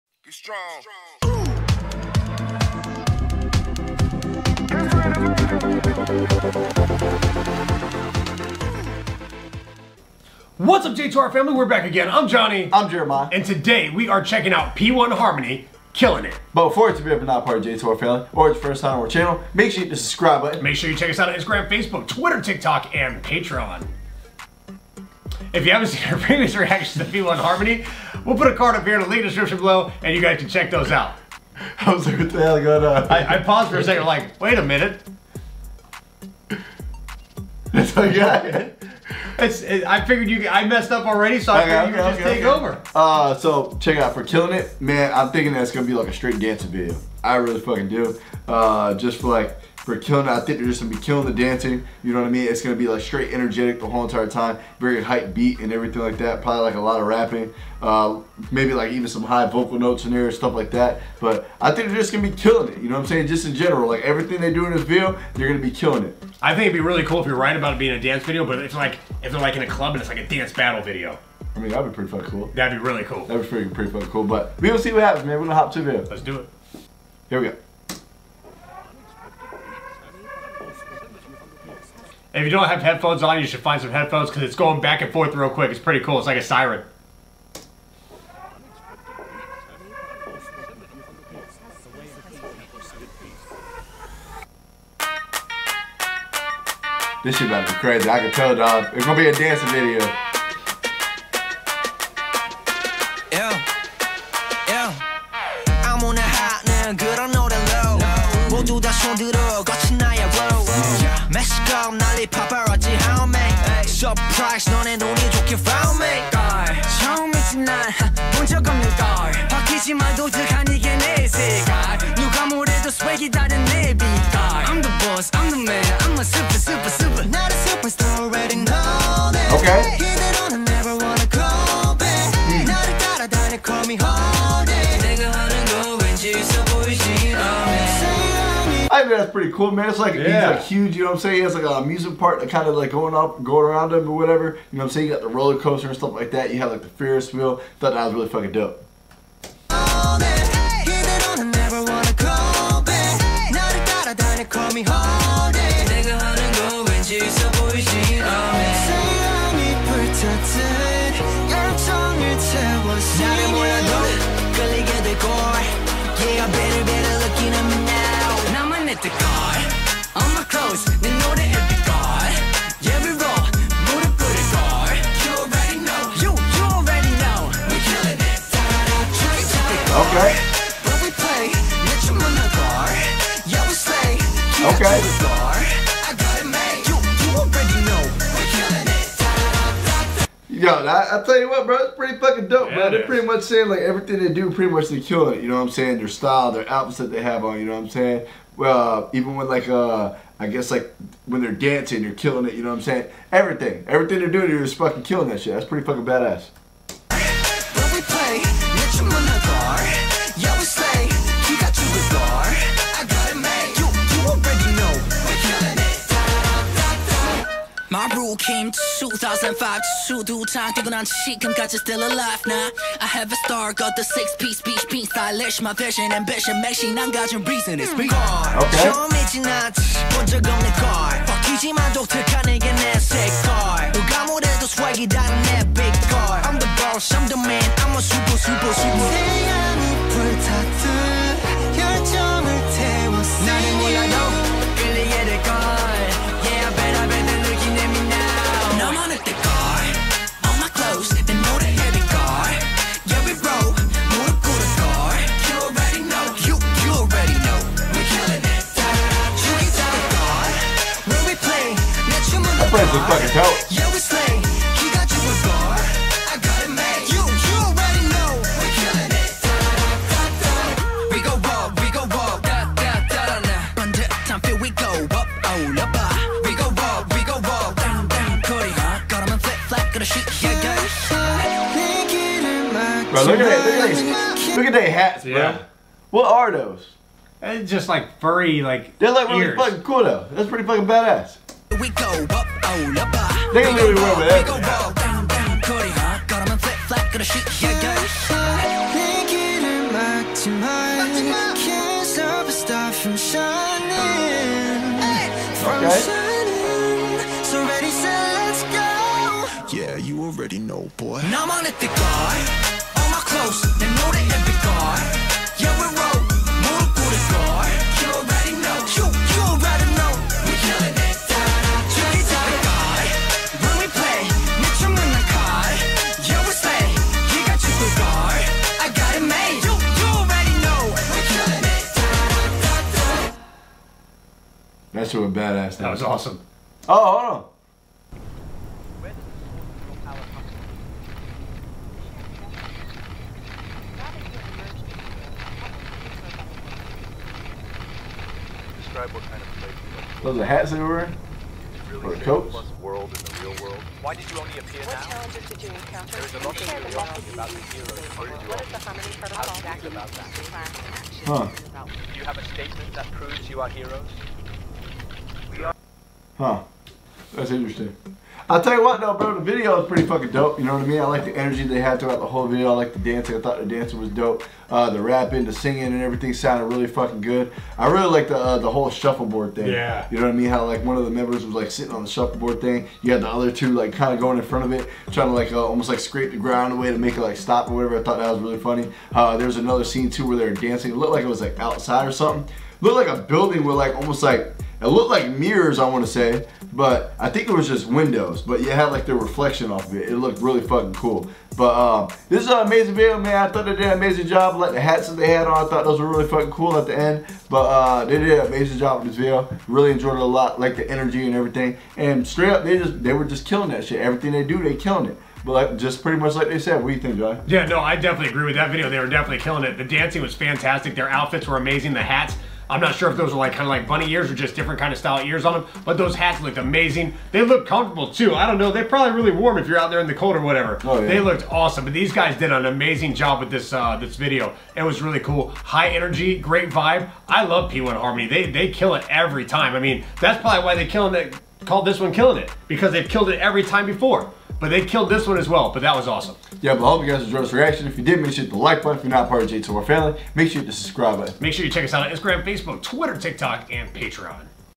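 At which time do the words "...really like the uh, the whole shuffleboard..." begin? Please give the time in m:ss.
6:17.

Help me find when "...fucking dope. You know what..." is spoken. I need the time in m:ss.
6:10.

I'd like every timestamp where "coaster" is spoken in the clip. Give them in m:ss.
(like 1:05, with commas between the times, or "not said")
2:25.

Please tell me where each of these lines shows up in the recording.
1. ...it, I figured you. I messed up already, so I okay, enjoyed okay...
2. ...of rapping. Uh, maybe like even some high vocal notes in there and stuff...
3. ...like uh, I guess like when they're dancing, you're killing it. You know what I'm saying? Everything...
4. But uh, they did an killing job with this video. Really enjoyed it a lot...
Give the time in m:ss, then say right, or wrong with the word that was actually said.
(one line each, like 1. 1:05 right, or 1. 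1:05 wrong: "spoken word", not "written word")
1. 0:39 wrong: "figured", not "enjoyed"
2. 0:57 right
3. 3:19 right
4. 6:47 wrong: "amazing", not "killing".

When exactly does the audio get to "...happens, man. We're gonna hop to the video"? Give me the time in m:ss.
1:15.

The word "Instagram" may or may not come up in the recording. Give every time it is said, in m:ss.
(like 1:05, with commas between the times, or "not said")
0:21, 7:32.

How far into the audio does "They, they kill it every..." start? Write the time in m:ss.
7:18.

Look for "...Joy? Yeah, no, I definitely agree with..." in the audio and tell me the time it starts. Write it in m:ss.
6:57.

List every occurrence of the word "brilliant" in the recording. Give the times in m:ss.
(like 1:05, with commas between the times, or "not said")
not said.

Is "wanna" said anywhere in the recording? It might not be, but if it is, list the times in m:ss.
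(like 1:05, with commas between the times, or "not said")
6:35.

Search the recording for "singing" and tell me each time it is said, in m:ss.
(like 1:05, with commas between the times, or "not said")
6:15.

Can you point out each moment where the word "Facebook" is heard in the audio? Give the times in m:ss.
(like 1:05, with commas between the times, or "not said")
0:21, 7:32.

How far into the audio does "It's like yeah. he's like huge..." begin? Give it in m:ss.
2:19.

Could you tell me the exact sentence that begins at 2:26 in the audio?
You have like the Ferris wheel.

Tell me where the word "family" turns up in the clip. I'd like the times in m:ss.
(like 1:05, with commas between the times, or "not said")
0:11, 0:17, 7:29.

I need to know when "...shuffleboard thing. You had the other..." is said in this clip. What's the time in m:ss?
6:22.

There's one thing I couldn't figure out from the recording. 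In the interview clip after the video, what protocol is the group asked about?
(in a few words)
Harmony protocol.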